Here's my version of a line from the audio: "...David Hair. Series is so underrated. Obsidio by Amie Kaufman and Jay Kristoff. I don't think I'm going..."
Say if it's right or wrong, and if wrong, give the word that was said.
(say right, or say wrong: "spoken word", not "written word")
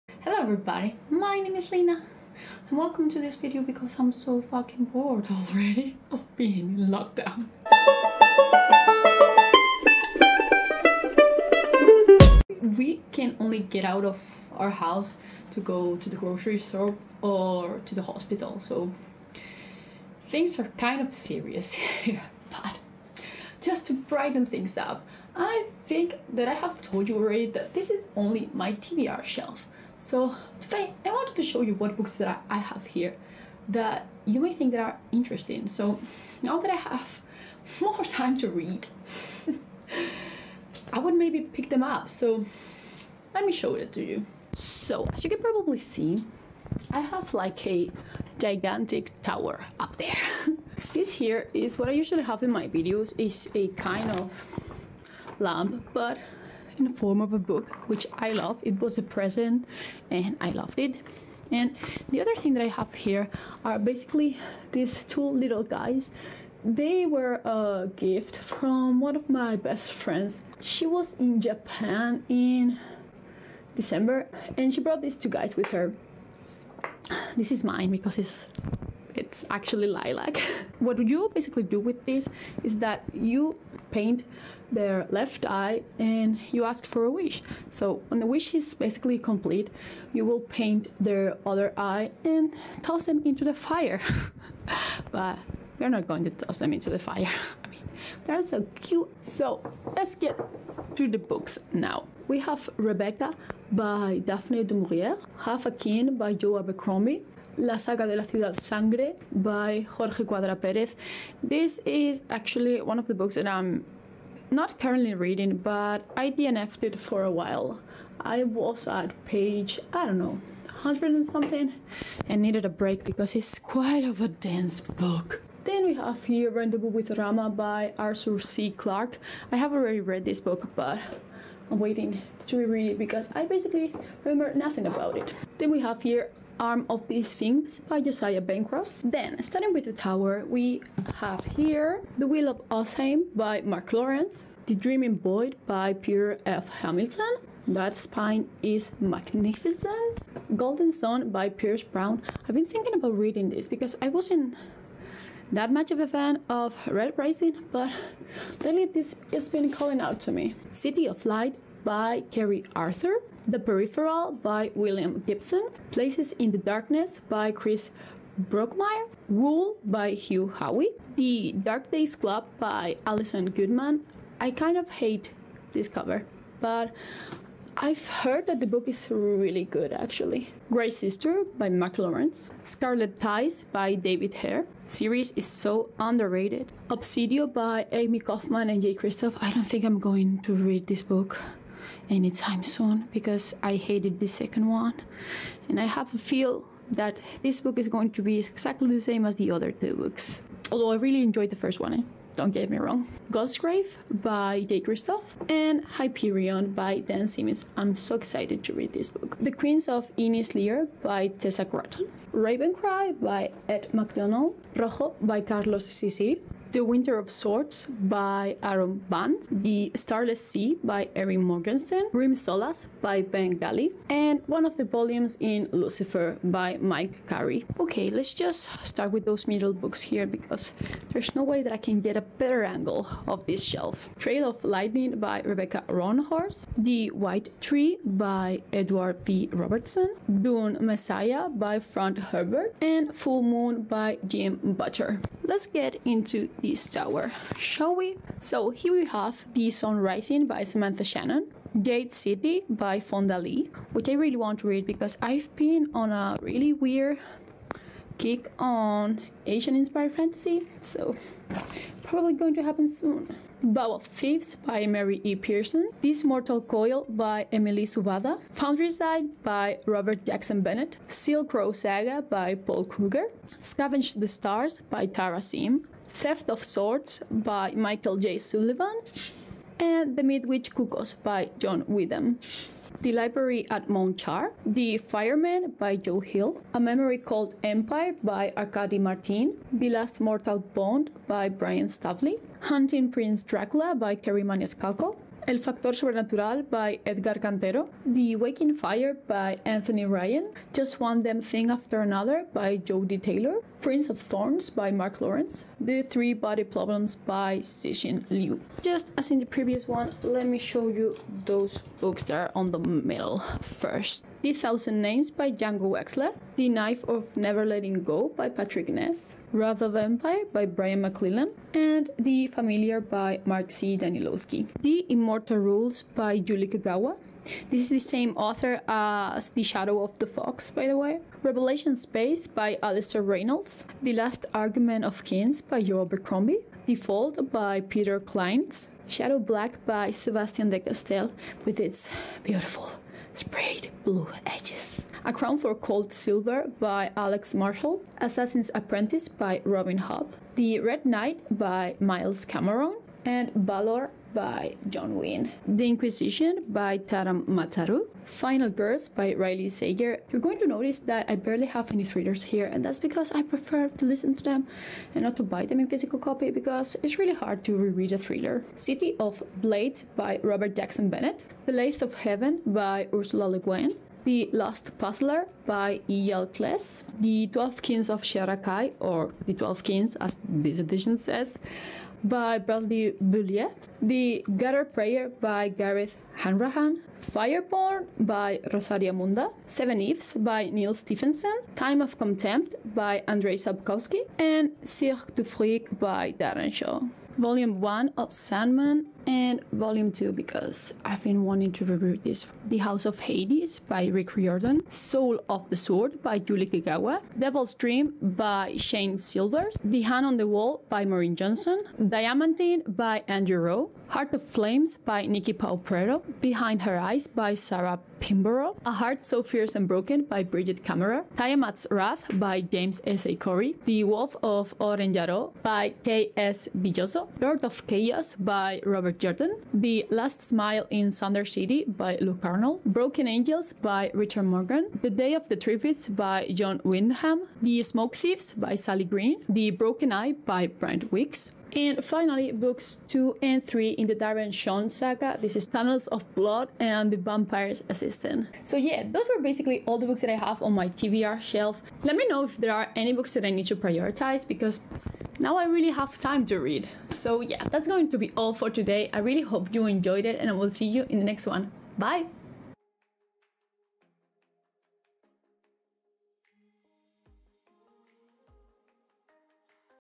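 right.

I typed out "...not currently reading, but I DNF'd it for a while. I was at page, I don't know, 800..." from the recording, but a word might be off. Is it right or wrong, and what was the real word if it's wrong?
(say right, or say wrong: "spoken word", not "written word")
wrong: "100", not "800".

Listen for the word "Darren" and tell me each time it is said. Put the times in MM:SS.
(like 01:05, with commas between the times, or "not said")
06:36, 07:24.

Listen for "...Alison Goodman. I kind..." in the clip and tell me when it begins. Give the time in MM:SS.
02:53.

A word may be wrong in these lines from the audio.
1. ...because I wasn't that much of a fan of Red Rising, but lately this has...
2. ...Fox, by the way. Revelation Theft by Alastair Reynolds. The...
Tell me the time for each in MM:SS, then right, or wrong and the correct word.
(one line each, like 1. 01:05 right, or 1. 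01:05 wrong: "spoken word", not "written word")
1. 02:33 right
2. 05:30 wrong: "Space", not "Theft".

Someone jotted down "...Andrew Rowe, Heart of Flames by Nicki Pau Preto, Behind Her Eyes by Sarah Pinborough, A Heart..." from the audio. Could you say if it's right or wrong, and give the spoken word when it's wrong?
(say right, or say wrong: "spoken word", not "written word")
right.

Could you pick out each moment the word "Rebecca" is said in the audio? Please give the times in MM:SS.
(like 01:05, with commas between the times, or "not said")
01:42, 03:55.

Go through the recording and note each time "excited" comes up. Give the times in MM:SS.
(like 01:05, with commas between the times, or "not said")
03:28.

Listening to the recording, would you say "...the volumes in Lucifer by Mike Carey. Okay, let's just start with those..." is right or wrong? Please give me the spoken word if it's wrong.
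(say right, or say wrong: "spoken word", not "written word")
right.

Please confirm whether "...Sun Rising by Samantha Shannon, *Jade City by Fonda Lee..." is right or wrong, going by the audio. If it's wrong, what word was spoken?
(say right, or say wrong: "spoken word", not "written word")
right.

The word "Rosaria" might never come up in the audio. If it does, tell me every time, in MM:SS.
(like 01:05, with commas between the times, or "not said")
06:28.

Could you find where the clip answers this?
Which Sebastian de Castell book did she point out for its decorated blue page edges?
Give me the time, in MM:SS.
05:39.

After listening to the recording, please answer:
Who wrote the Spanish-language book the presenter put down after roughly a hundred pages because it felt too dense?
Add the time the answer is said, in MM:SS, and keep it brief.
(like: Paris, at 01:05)
Jorge Cuadra Perez, at 01:49.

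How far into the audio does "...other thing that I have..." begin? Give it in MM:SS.
01:02.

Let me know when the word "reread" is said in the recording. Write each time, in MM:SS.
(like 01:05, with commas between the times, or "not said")
02:12, 06:07.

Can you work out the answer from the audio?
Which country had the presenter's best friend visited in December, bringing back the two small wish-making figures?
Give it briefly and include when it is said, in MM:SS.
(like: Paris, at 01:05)
Japan, at 01:11.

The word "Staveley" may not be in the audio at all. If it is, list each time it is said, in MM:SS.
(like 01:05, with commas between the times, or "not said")
04:51.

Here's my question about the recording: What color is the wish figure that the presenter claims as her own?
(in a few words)
Lilac.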